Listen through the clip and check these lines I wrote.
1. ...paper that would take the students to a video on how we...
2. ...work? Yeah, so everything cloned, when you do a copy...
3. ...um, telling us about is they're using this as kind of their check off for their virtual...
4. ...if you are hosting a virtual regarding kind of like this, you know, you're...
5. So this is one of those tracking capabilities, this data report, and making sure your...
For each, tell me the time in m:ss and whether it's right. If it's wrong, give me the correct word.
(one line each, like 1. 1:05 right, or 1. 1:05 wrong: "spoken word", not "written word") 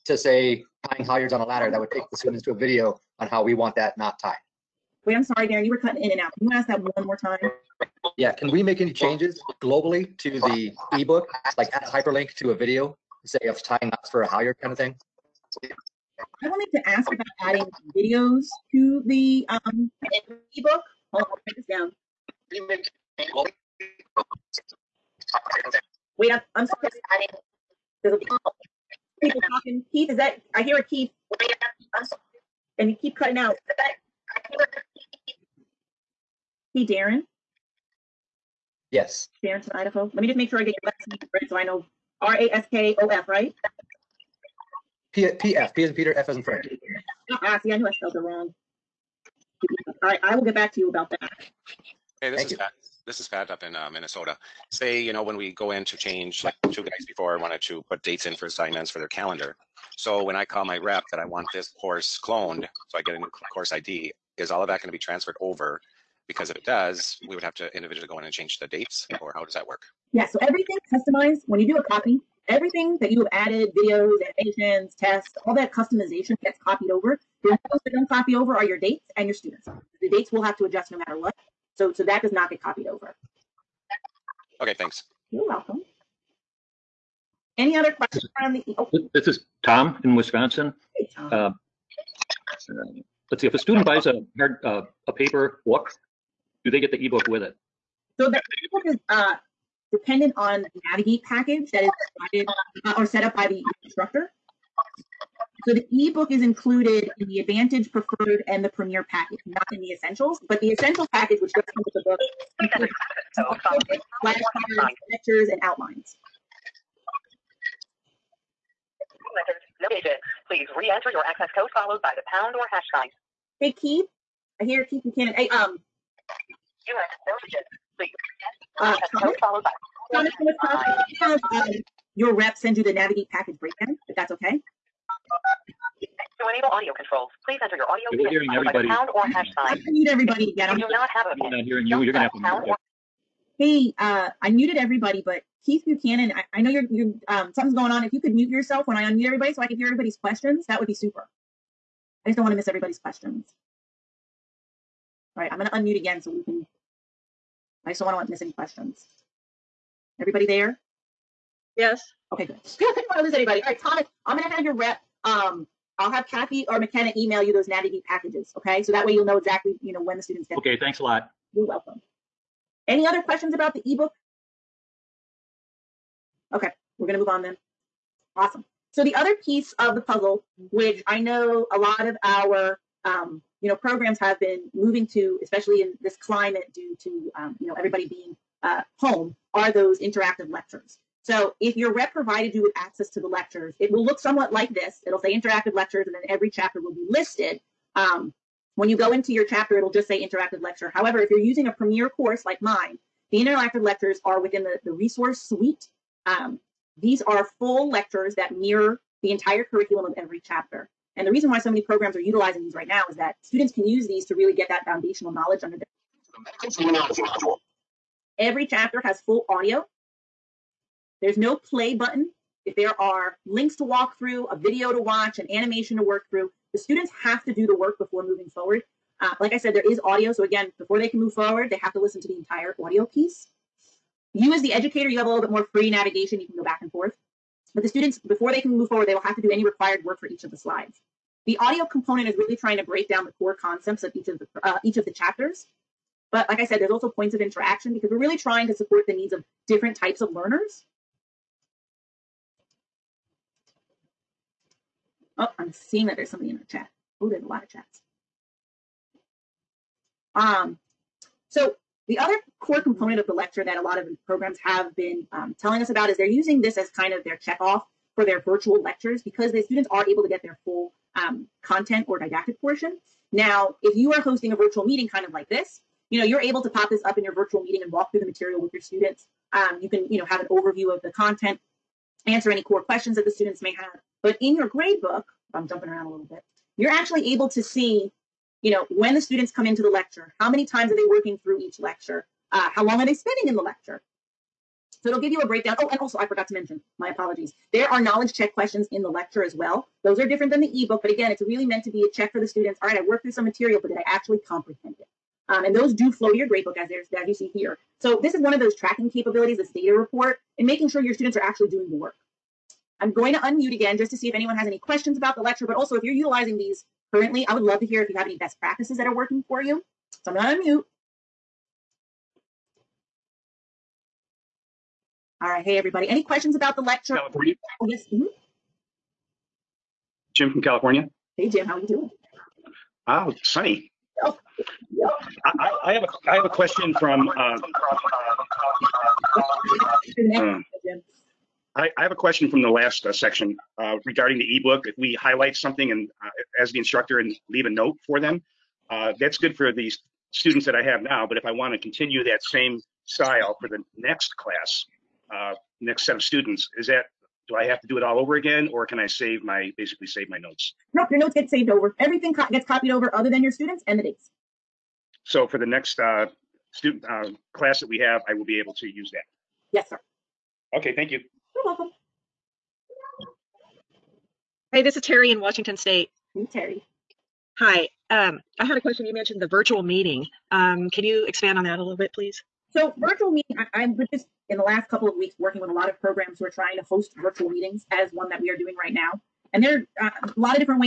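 1. 0:01 wrong: "ladder", not "paper"
2. 1:09 wrong: "customized", not "cloned"
3. 4:25 right
4. 4:33 wrong: "meeting", not "regarding"
5. 5:07 right.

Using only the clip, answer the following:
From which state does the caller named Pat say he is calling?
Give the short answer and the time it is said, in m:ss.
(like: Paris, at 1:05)
Minnesota, at 0:53.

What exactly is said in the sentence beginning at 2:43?
All right, Thomas, I'm going to have your rep.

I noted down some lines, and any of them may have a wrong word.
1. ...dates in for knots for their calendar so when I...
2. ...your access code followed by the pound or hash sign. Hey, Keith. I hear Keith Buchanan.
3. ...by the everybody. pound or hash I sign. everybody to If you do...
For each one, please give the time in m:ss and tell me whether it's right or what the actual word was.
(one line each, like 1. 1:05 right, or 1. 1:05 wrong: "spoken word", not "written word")
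1. 0:58 wrong: "assignments", not "knots"
2. 2:01 right
3. 2:18 right.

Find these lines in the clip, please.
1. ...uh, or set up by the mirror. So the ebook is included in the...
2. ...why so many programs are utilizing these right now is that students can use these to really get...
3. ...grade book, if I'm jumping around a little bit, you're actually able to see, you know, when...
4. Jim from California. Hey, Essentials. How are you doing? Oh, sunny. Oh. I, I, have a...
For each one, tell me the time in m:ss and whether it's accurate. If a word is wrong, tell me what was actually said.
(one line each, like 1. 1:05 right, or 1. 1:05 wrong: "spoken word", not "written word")
1. 1:42 wrong: "instructor", not "mirror"
2. 3:31 right
3. 4:44 right
4. 5:30 wrong: "Jim", not "Essentials".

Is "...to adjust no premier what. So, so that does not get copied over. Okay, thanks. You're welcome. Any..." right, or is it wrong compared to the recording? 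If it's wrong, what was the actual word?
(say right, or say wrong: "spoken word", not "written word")
wrong: "matter", not "premier".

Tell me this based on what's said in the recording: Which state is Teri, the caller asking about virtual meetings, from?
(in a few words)
Washington State.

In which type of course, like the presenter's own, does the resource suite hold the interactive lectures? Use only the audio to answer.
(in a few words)
premier course.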